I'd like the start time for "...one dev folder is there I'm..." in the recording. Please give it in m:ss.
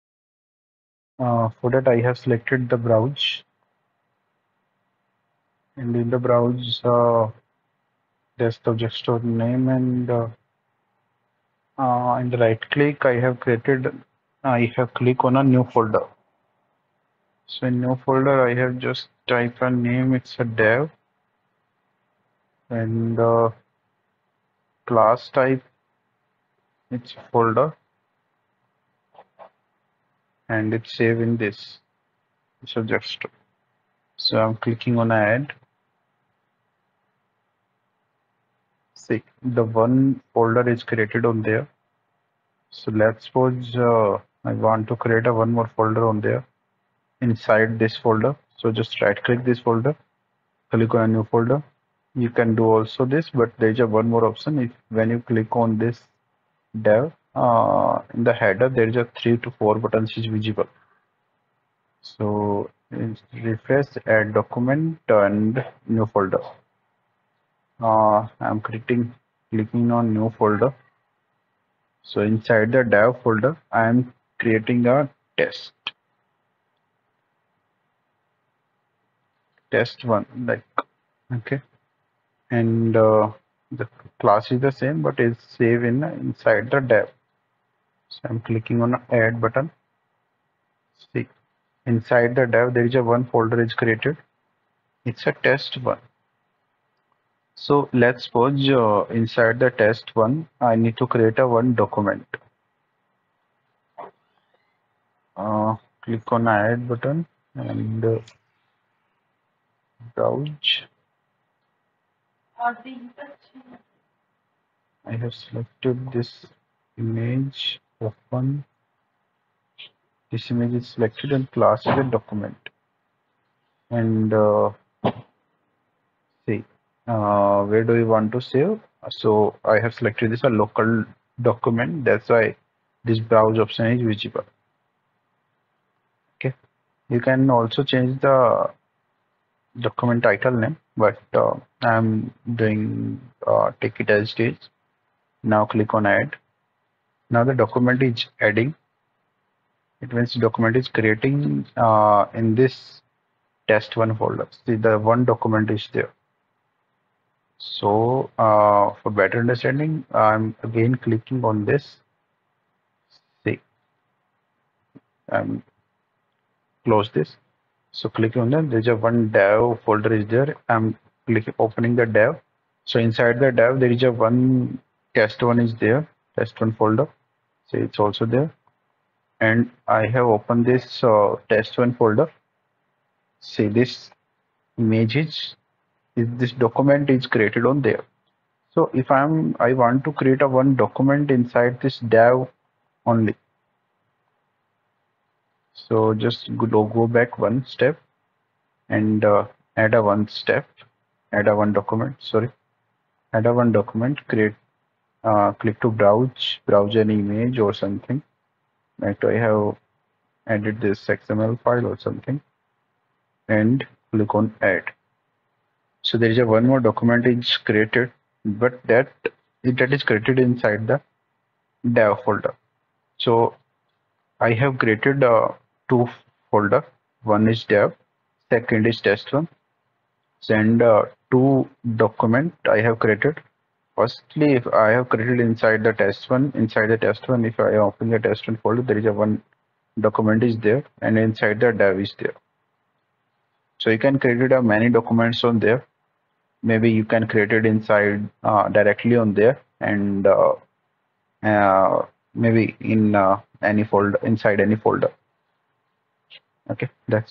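2:48.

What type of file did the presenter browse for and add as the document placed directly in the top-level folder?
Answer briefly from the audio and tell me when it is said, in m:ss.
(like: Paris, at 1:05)
XML file, at 3:31.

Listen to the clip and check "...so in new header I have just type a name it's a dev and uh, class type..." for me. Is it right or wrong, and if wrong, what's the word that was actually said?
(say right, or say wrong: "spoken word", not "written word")
wrong: "folder", not "header".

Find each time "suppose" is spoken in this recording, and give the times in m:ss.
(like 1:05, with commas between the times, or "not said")
0:43, 1:38.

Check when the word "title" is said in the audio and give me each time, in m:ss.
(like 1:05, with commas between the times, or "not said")
2:20.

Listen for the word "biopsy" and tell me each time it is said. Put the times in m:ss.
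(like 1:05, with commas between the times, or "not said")
not said.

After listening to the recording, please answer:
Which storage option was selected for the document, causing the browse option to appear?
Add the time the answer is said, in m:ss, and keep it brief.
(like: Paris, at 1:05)
local document, at 2:10.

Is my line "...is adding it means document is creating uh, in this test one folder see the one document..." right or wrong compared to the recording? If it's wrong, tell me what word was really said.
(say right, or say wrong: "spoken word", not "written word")
right.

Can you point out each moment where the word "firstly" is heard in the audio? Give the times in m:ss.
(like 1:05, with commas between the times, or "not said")
3:54.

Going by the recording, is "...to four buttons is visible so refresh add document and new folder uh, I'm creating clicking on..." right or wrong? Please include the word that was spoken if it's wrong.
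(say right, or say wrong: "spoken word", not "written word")
right.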